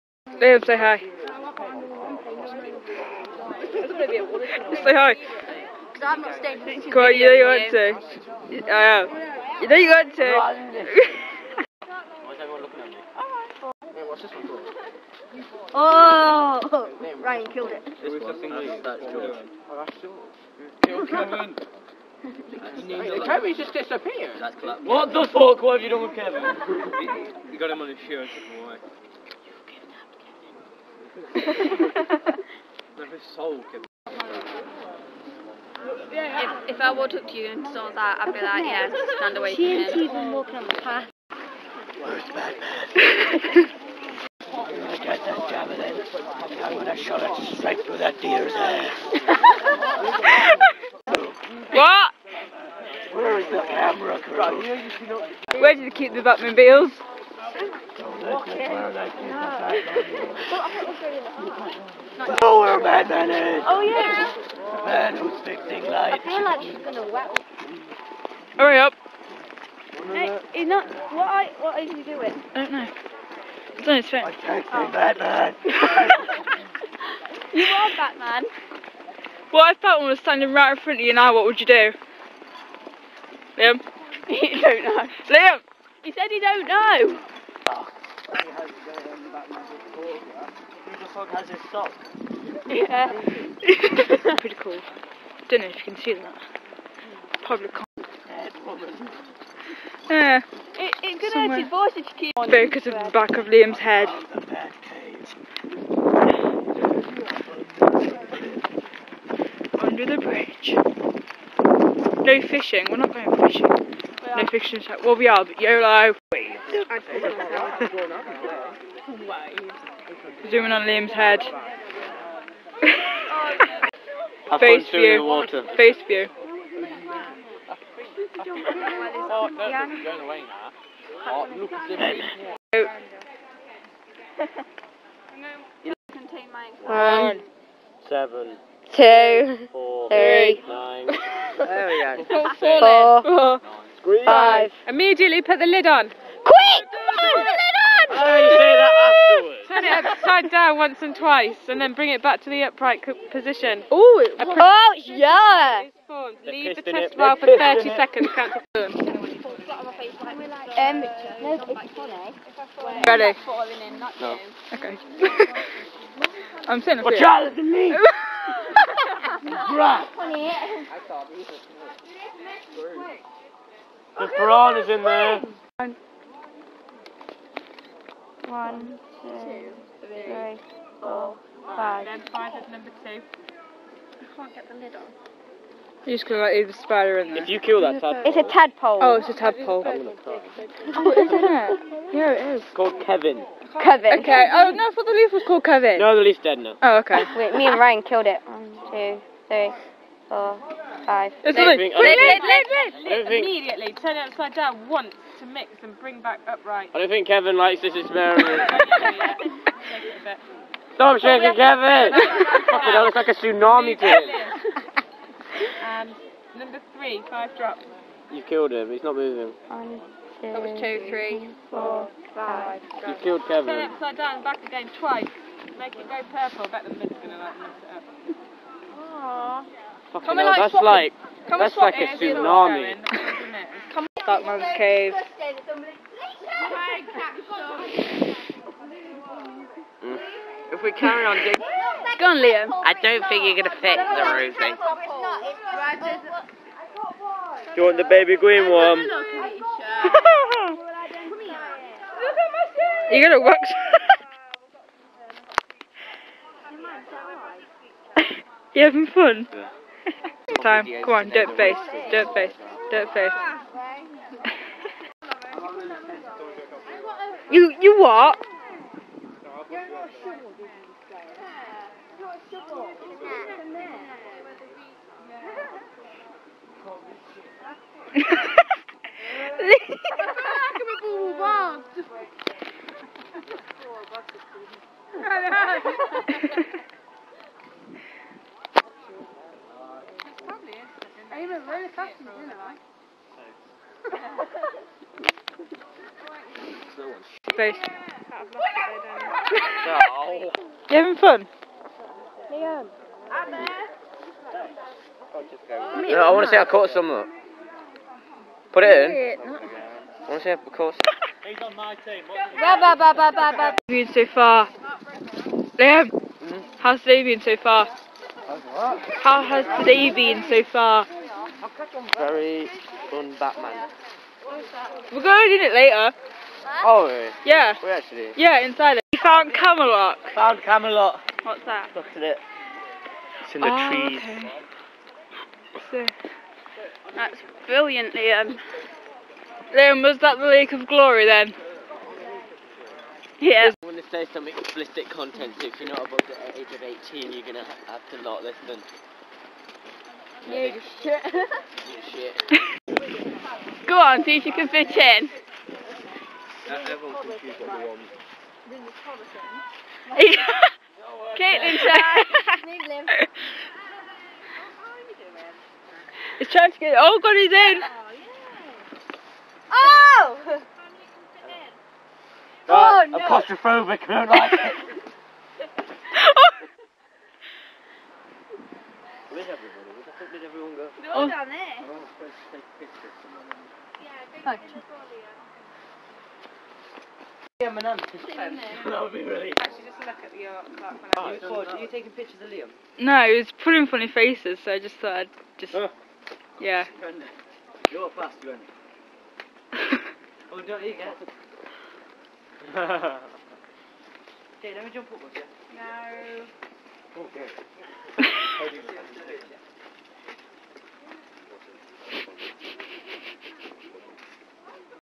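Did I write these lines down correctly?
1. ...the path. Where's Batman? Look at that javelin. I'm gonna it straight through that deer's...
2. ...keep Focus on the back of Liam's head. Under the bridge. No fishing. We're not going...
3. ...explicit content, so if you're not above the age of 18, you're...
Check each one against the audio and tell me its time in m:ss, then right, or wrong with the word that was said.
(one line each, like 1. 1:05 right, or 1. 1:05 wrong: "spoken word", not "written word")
1. 0:40 right
2. 1:42 right
3. 5:44 right.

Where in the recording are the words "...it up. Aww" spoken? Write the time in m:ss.
3:48.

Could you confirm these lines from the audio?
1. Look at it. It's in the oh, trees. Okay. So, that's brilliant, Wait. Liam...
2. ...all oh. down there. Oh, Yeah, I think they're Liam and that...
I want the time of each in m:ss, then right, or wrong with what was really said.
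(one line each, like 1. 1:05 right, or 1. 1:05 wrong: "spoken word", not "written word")
1. 5:31 wrong: "Liam", not "Wait"
2. 6:21 right.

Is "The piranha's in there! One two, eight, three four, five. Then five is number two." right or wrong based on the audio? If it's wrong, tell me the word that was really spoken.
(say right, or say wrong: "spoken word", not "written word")
wrong: "three", not "eight".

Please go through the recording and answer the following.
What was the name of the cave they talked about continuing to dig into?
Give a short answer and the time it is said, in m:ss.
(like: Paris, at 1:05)
Dark Man's Cave, at 3:54.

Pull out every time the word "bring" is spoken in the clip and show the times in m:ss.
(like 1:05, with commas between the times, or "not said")
2:31, 3:25.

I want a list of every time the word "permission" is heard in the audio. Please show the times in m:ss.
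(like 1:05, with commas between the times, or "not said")
not said.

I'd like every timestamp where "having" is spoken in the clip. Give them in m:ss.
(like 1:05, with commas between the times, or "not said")
4:18, 5:00.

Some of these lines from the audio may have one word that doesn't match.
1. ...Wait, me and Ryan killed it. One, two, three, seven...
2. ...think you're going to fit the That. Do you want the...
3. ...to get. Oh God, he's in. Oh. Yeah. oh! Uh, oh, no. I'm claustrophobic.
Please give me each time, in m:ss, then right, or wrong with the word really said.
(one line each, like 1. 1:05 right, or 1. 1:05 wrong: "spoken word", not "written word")
1. 3:17 wrong: "four", not "seven"
2. 4:03 wrong: "Rosie", not "That"
3. 6:06 right.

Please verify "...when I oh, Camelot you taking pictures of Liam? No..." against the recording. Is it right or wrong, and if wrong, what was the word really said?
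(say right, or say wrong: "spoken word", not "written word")
wrong: "Are", not "Camelot".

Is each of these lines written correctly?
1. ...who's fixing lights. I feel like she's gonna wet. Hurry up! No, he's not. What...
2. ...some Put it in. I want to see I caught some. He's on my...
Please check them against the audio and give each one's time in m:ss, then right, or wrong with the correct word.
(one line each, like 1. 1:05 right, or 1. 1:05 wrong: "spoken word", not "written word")
1. 1:05 right
2. 5:06 right.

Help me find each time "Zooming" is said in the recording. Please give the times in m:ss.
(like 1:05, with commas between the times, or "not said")
2:00.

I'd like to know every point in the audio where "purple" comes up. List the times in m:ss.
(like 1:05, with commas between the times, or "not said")
3:46.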